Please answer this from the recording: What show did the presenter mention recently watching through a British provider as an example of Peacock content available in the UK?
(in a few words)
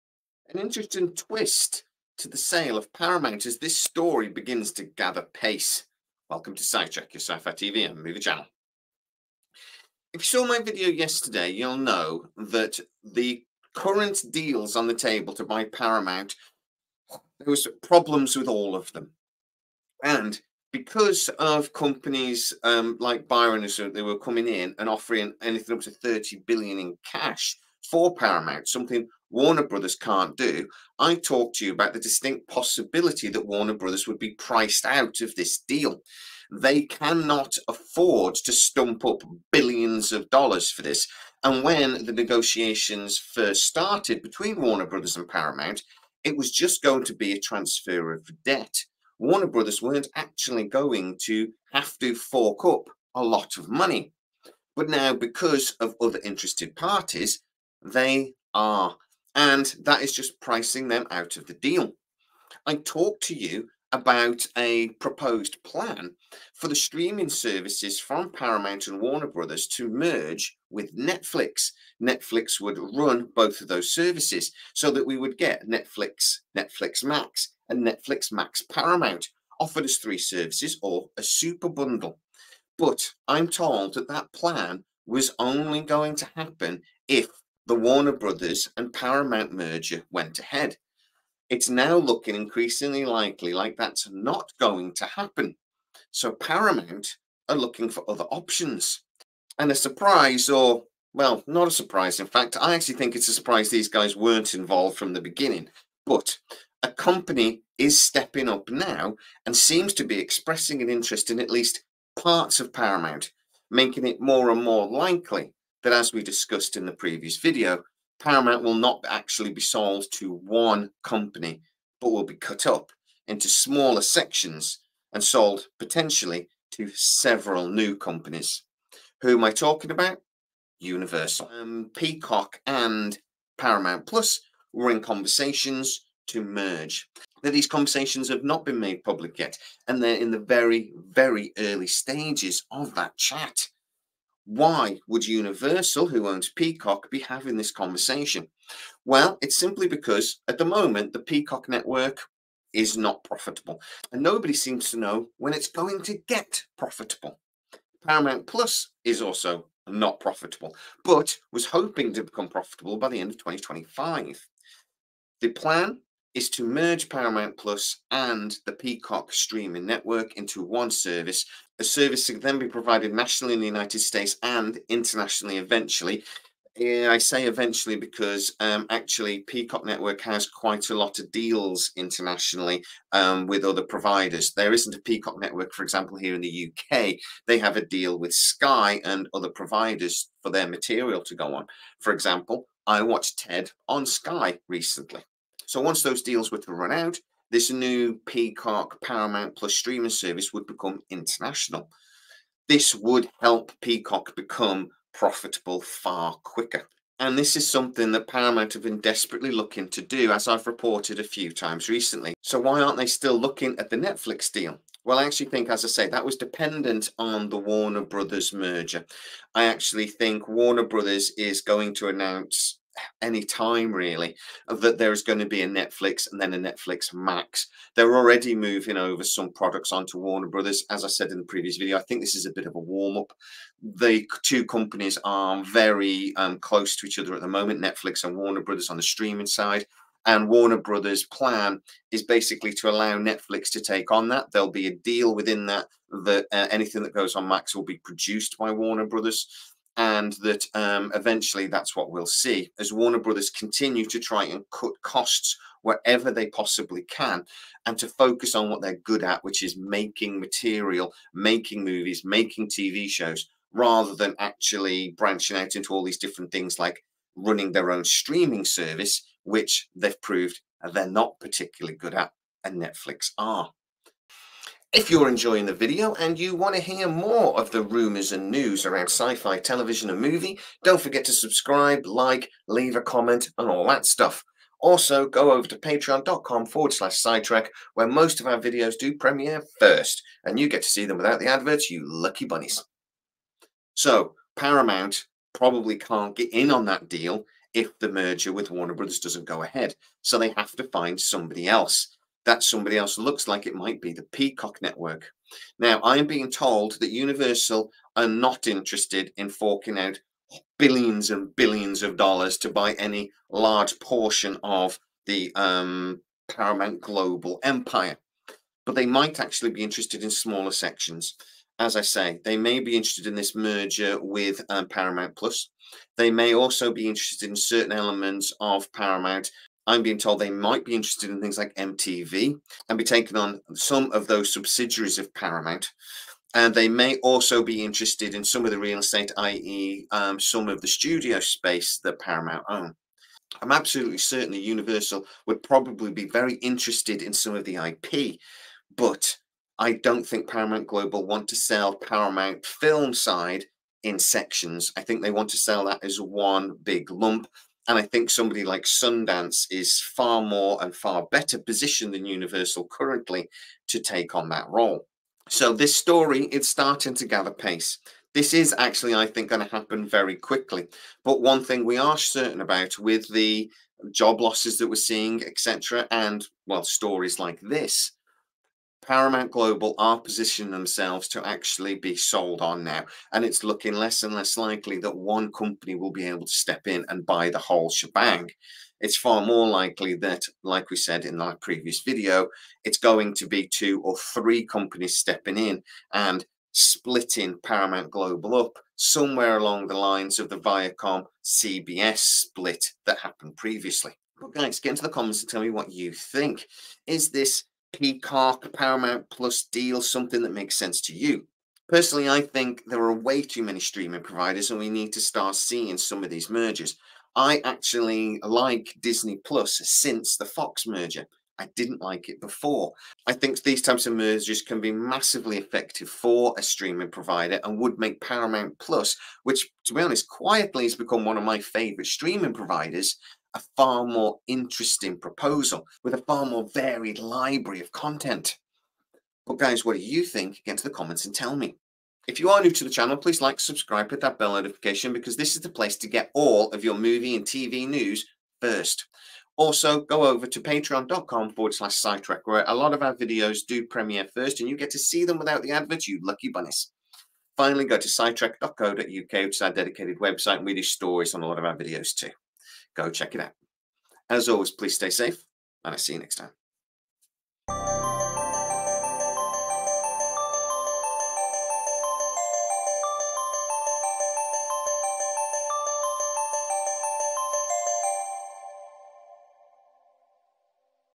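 TED.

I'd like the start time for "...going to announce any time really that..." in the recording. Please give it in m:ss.
3:41.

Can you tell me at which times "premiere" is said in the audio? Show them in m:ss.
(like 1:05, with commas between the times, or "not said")
4:49, 7:33.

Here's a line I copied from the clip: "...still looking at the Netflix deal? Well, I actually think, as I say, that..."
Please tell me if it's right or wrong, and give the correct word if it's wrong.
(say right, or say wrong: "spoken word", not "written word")
right.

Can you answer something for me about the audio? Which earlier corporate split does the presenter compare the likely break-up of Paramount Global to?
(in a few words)
Viacom CBS split.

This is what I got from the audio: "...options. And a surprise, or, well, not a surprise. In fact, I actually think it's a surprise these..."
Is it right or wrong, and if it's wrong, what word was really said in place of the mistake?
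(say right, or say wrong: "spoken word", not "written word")
right.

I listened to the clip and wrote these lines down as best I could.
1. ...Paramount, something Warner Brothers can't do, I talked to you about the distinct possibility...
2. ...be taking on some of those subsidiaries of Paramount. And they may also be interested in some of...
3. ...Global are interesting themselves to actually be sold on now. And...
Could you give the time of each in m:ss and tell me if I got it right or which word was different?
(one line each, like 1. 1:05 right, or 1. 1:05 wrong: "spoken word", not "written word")
1. 0:28 right
2. 5:32 right
3. 6:19 wrong: "positioning", not "interesting".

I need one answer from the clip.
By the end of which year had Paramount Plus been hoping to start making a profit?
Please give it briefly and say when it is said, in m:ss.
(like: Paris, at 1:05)
2025, at 2:43.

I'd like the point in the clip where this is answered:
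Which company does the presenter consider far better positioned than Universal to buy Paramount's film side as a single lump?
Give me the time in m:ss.
5:58.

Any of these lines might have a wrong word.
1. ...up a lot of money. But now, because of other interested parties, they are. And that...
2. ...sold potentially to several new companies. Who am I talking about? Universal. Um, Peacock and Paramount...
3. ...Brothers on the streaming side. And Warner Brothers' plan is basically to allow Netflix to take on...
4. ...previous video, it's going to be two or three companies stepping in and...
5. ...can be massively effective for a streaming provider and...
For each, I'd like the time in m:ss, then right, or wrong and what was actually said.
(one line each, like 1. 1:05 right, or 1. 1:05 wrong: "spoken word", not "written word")
1. 0:52 right
2. 2:05 right
3. 3:58 right
4. 6:31 right
5. 7:04 right.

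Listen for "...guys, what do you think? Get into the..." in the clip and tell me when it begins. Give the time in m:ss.
7:19.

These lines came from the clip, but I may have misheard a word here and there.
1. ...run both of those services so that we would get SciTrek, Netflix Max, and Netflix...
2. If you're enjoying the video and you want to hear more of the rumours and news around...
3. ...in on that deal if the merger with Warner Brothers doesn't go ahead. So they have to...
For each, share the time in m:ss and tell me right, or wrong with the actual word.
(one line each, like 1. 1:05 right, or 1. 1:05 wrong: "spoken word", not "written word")
1. 1:12 wrong: "Netflix", not "SciTrek"
2. 4:34 right
3. 4:56 right.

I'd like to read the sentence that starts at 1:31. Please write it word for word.
It's now looking increasingly likely like that's not going to happen.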